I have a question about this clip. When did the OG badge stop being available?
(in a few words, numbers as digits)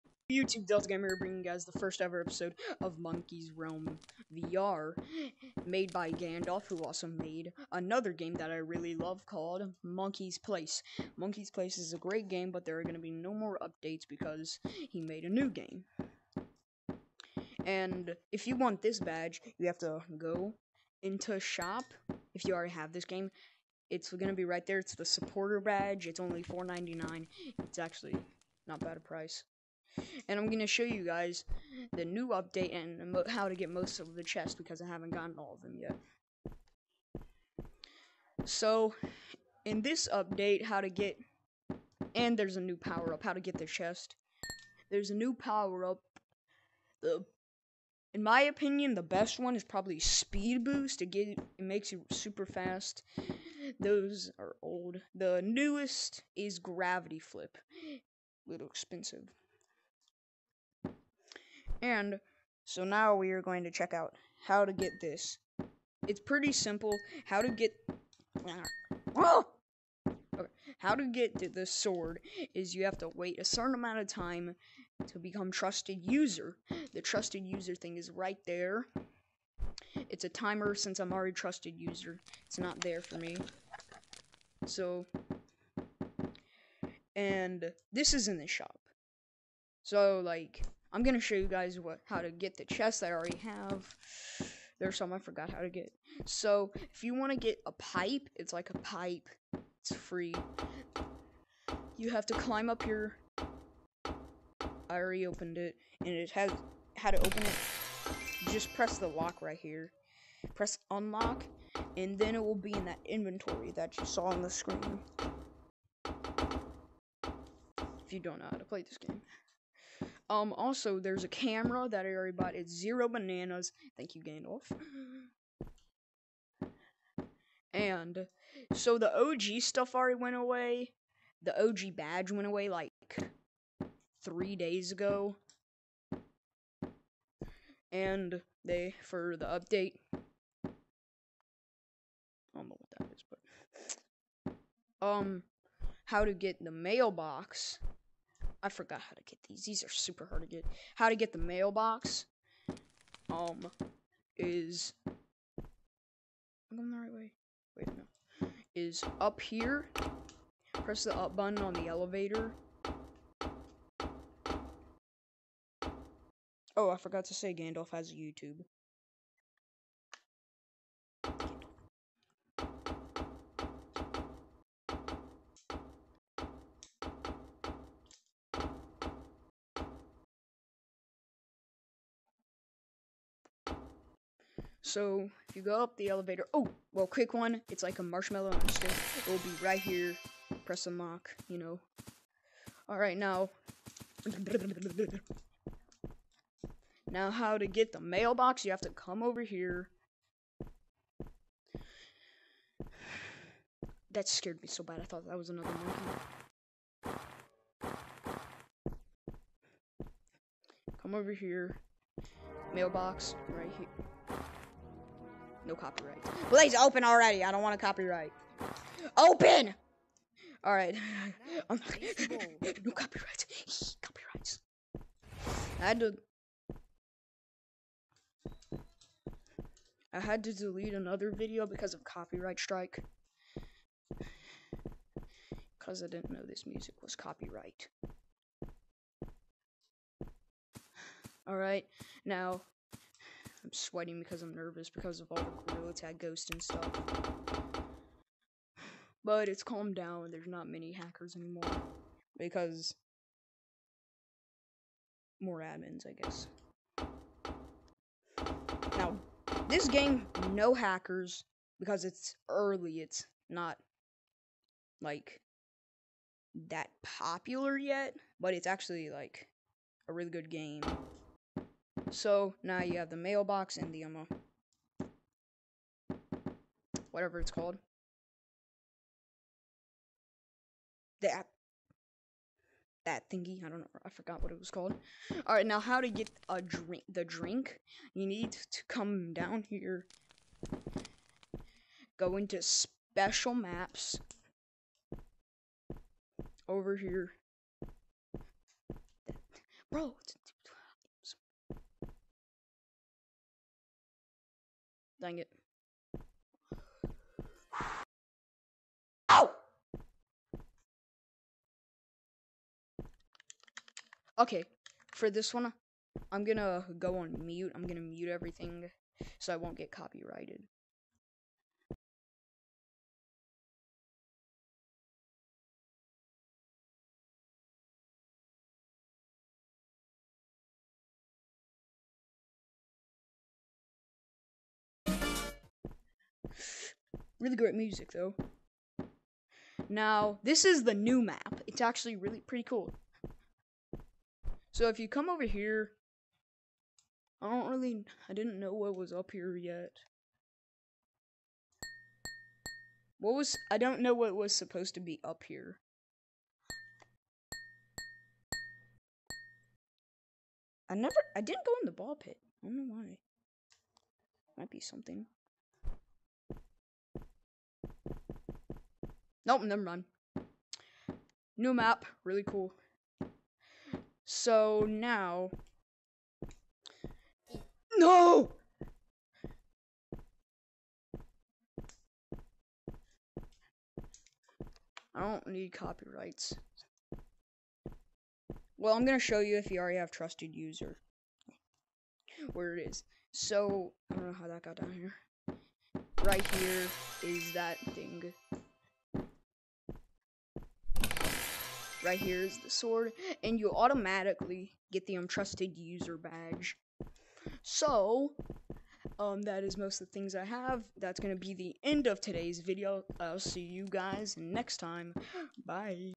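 three days ago.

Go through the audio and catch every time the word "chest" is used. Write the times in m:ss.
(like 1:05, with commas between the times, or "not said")
0:34, 0:43, 1:32.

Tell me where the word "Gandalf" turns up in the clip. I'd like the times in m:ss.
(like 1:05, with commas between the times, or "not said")
0:06, 2:04, 2:47.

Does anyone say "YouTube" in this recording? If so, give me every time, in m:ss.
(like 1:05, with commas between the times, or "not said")
0:00, 2:48.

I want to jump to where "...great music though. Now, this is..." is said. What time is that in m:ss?
5:37.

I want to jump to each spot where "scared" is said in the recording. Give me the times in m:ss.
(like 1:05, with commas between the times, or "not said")
3:24.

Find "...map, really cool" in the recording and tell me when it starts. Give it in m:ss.
6:11.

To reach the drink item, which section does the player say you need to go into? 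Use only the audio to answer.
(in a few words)
special maps.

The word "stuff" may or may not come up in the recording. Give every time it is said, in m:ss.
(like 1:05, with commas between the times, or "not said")
2:09, 4:06.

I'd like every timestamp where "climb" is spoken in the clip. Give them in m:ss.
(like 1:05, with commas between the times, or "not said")
1:42.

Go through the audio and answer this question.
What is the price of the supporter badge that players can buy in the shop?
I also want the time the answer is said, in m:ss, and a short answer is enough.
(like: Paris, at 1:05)
$4.99, at 0:26.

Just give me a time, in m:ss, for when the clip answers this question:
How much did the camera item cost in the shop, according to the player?
2:02.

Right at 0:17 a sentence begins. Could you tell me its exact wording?
And if you want this badge, you have to go into shop if you already have this game.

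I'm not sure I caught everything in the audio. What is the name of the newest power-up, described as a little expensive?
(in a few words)
gravity flip.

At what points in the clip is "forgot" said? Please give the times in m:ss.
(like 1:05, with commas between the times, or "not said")
1:35, 2:28, 2:46, 4:44.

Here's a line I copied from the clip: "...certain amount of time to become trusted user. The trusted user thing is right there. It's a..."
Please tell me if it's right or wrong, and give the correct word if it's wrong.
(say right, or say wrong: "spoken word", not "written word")
right.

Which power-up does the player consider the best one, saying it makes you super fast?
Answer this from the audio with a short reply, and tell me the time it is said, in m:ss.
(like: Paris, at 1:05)
speed boost, at 0:49.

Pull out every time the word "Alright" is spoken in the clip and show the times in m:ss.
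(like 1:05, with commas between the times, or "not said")
3:40, 4:01, 4:45.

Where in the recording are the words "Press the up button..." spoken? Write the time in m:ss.
2:40.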